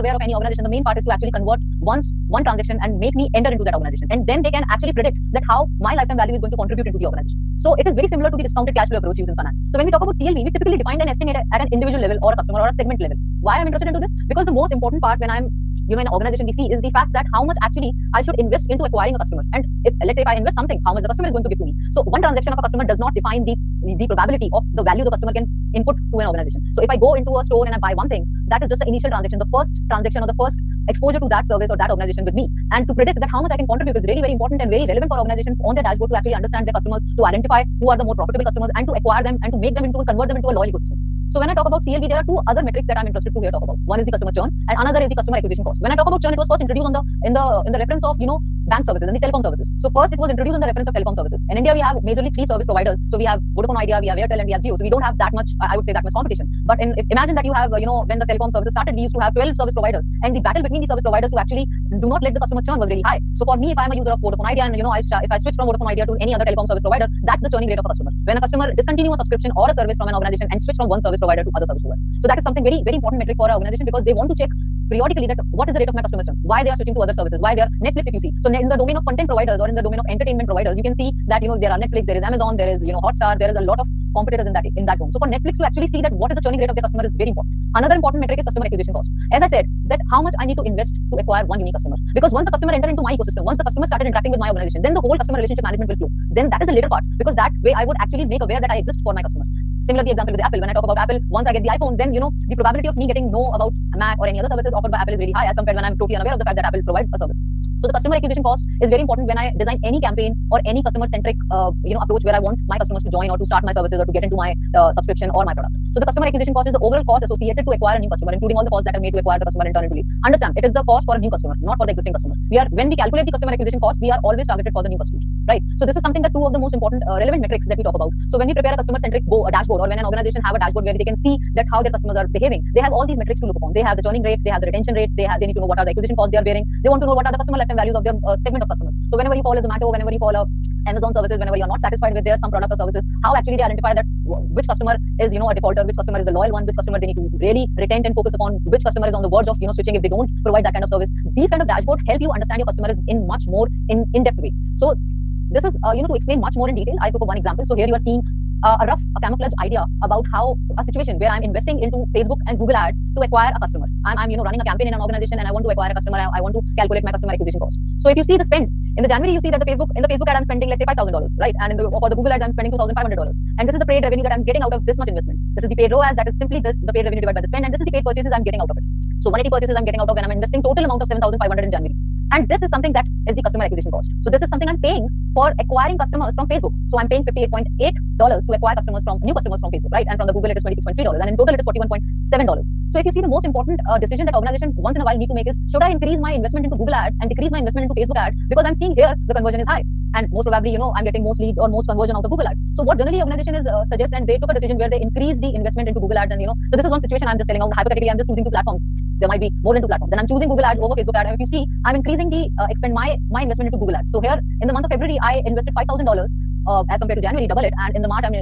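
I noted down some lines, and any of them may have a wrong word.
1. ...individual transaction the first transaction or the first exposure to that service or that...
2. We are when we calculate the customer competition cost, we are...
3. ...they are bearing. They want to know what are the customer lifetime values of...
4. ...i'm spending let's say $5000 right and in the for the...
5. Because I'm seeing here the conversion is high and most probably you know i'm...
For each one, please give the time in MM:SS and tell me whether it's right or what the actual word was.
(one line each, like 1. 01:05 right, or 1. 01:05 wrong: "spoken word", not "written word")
1. 00:28 wrong: "initial", not "individual"
2. 02:02 wrong: "acquisition", not "competition"
3. 02:16 right
4. 02:50 right
5. 03:18 right.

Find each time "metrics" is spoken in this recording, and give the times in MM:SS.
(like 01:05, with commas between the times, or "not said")
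00:42, 01:13, 01:28, 02:07, 02:13.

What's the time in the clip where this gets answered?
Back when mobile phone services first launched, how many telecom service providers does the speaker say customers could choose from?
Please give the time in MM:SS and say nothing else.
00:59.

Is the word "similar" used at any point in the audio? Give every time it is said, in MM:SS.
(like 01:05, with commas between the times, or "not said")
00:08, 01:39.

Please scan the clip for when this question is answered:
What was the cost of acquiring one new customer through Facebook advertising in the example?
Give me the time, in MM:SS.
03:07.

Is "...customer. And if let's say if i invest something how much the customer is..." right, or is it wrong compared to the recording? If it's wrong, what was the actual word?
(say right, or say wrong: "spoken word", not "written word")
right.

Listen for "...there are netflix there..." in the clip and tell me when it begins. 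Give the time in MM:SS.
01:21.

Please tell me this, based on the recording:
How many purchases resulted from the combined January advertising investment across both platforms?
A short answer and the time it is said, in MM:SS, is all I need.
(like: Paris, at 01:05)
180, at 02:59.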